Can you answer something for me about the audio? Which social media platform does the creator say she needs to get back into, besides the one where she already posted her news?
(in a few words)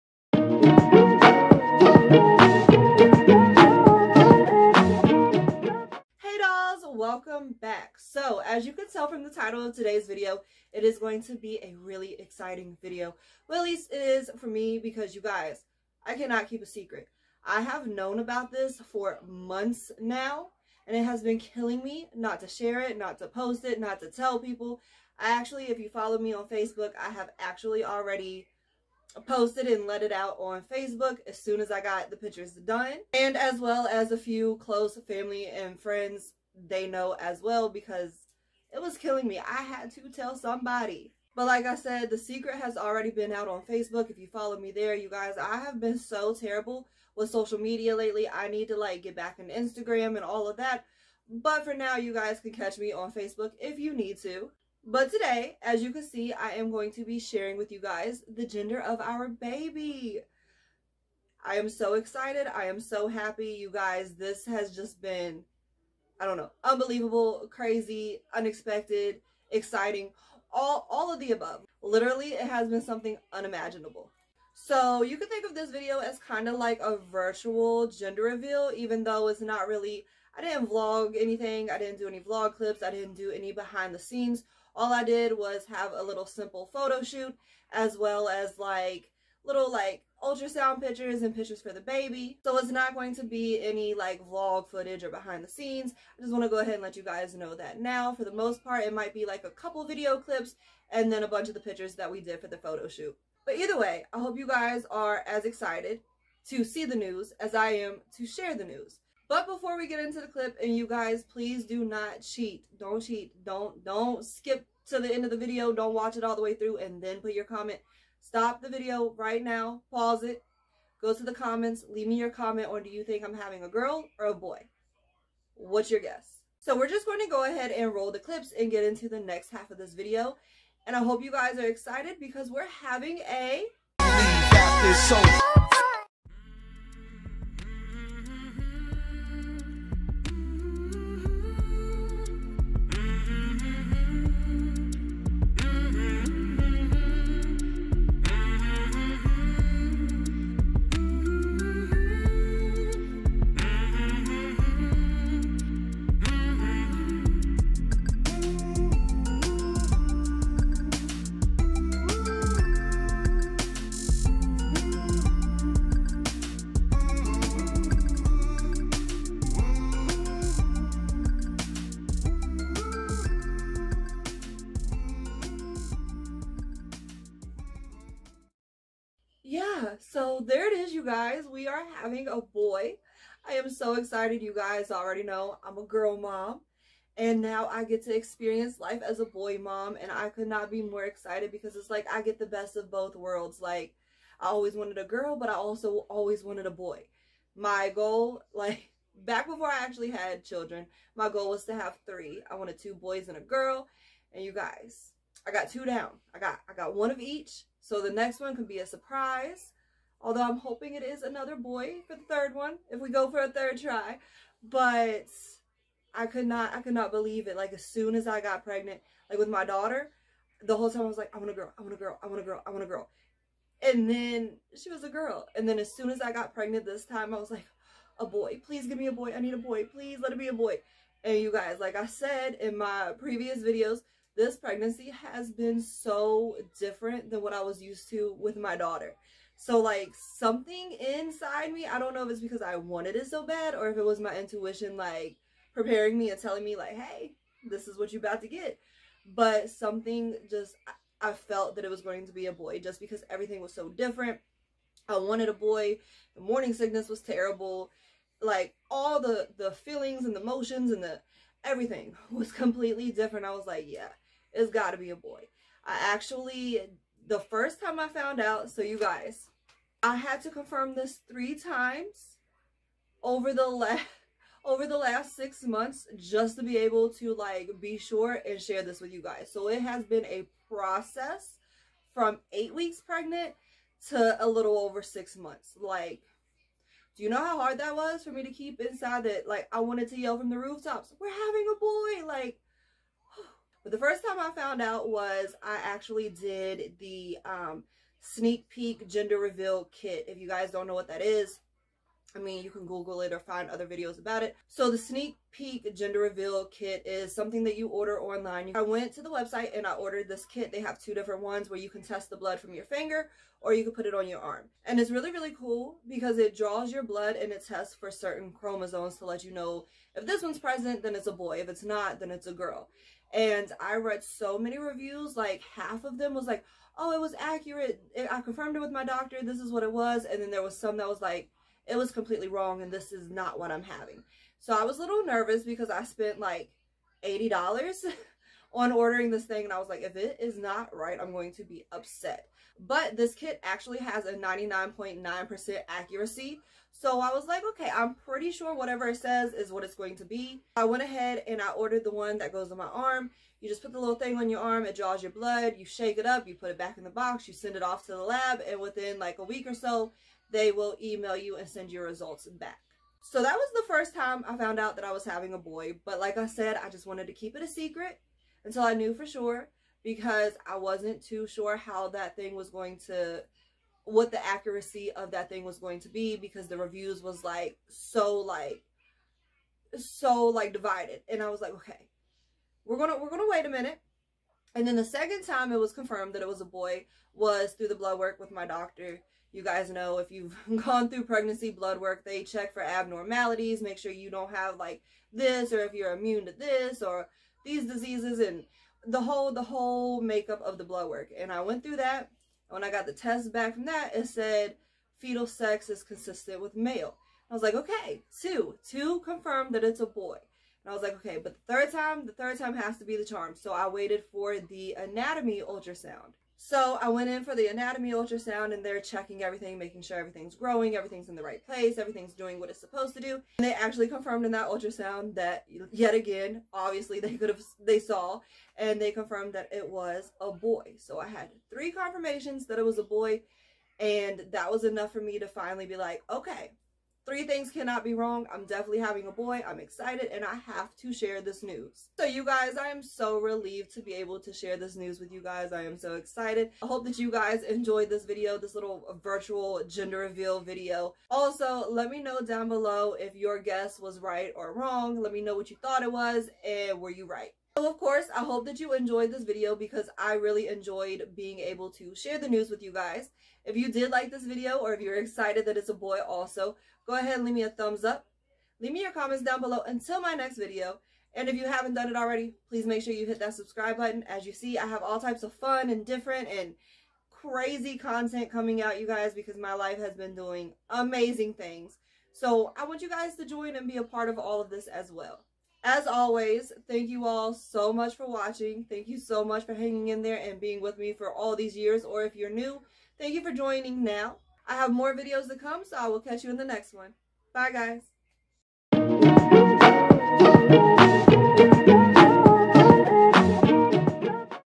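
Instagram.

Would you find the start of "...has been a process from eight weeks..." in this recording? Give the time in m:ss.
4:39.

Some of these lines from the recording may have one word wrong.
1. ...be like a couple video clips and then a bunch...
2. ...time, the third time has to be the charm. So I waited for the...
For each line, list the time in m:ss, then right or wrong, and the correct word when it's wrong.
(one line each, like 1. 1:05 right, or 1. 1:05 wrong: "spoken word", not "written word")
1. 1:39 right
2. 6:51 right.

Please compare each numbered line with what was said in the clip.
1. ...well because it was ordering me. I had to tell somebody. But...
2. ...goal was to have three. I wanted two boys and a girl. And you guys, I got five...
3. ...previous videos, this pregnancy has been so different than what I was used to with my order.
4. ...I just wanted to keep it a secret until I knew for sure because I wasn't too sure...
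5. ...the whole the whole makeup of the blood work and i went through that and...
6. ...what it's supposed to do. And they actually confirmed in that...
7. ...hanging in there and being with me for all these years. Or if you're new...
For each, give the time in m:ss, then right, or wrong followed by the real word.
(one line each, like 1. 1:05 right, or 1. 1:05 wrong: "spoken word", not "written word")
1. 0:37 wrong: "killing", not "ordering"
2. 3:21 wrong: "two", not "five"
3. 3:53 wrong: "daughter", not "order"
4. 6:06 right
5. 6:39 right
6. 7:02 right
7. 8:09 right.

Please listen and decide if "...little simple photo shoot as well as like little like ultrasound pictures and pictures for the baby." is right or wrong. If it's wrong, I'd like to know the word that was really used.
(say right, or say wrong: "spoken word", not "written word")
right.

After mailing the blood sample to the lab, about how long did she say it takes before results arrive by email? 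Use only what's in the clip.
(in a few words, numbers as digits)
a week or so.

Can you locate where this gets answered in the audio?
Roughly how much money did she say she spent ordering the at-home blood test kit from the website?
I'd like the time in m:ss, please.
5:37.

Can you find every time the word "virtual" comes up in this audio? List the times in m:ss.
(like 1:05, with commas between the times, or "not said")
1:16, 7:29.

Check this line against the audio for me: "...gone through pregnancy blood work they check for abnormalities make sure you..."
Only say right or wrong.
right.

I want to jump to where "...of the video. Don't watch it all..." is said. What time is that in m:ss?
1:55.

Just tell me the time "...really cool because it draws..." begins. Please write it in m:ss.
5:15.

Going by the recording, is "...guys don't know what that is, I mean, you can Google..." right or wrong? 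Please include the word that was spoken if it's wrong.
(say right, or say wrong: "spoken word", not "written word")
right.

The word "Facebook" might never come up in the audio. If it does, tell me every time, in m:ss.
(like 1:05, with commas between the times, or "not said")
0:26, 0:30, 0:43, 0:53.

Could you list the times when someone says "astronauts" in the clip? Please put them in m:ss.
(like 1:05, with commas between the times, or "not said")
not said.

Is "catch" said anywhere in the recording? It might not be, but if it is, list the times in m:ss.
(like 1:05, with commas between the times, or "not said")
0:52, 8:16.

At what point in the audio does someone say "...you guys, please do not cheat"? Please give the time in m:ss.
1:50.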